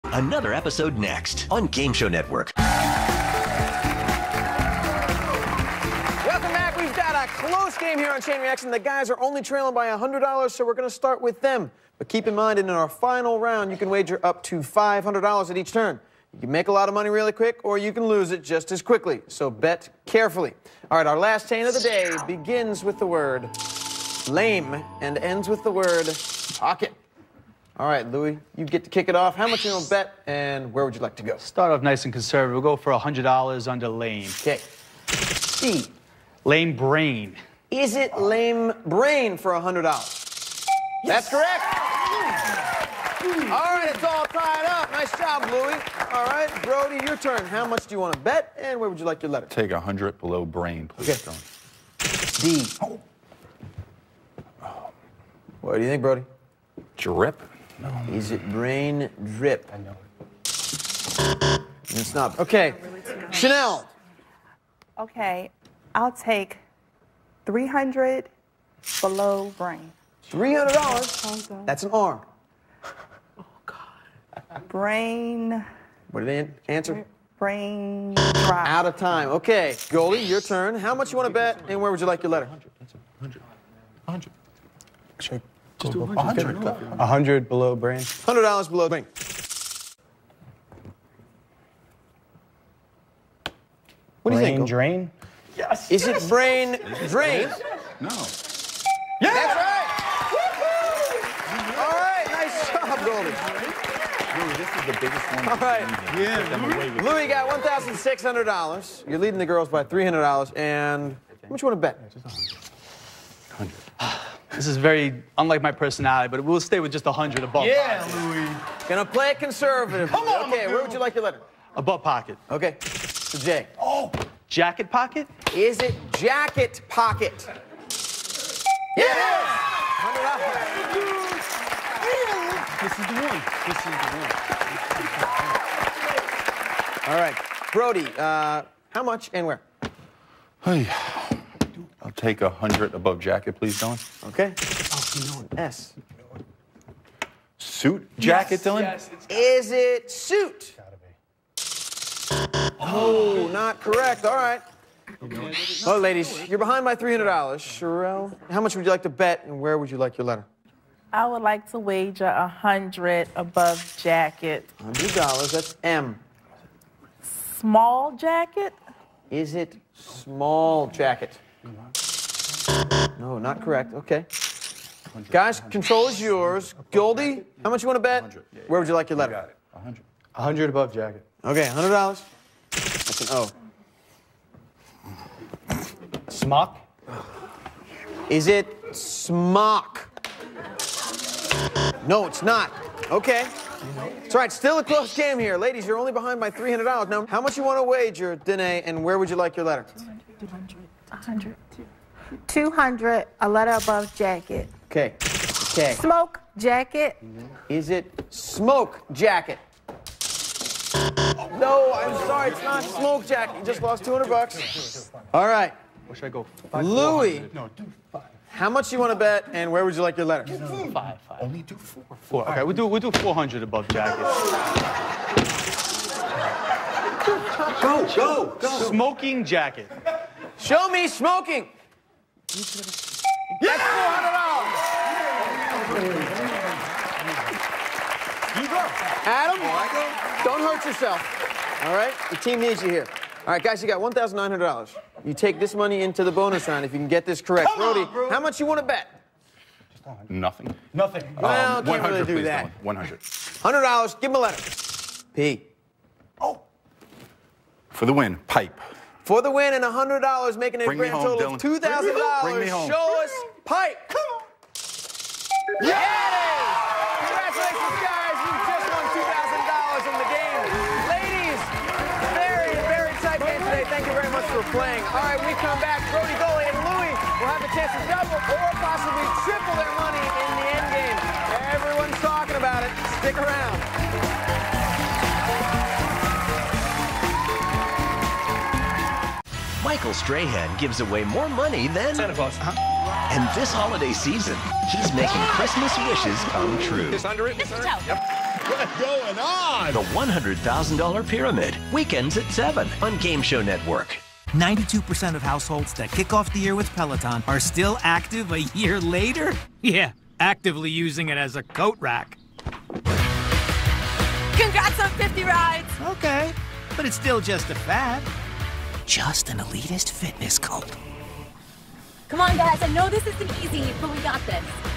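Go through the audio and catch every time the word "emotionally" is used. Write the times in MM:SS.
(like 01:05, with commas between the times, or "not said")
not said.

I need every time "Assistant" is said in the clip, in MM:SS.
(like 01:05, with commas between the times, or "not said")
not said.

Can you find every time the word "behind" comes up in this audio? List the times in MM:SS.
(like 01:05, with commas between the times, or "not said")
02:36, 03:16.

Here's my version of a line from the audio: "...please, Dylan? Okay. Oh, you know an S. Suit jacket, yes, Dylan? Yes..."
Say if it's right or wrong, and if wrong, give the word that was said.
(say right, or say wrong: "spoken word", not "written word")
right.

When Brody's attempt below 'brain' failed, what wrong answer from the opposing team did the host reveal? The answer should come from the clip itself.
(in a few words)
Brain drop.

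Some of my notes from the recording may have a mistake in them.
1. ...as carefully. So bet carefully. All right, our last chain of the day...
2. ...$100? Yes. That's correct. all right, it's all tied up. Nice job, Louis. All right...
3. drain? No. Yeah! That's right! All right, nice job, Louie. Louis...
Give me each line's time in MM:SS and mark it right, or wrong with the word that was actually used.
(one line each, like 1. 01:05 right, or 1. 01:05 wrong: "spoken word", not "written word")
1. 00:18 wrong: "quickly", not "carefully"
2. 00:39 right
3. 01:37 wrong: "Goldie", not "Louie".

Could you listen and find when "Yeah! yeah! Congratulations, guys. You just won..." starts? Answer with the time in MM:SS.
04:25.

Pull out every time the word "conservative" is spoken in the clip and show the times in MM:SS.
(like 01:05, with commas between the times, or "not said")
00:32, 01:59.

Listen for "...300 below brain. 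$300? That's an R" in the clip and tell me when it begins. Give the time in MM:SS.
01:07.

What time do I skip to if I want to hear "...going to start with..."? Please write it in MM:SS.
00:10.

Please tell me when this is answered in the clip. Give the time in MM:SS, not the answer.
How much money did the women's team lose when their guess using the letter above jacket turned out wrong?
03:34.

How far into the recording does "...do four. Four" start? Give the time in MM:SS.
03:41.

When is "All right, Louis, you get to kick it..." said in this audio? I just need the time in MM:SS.
00:27.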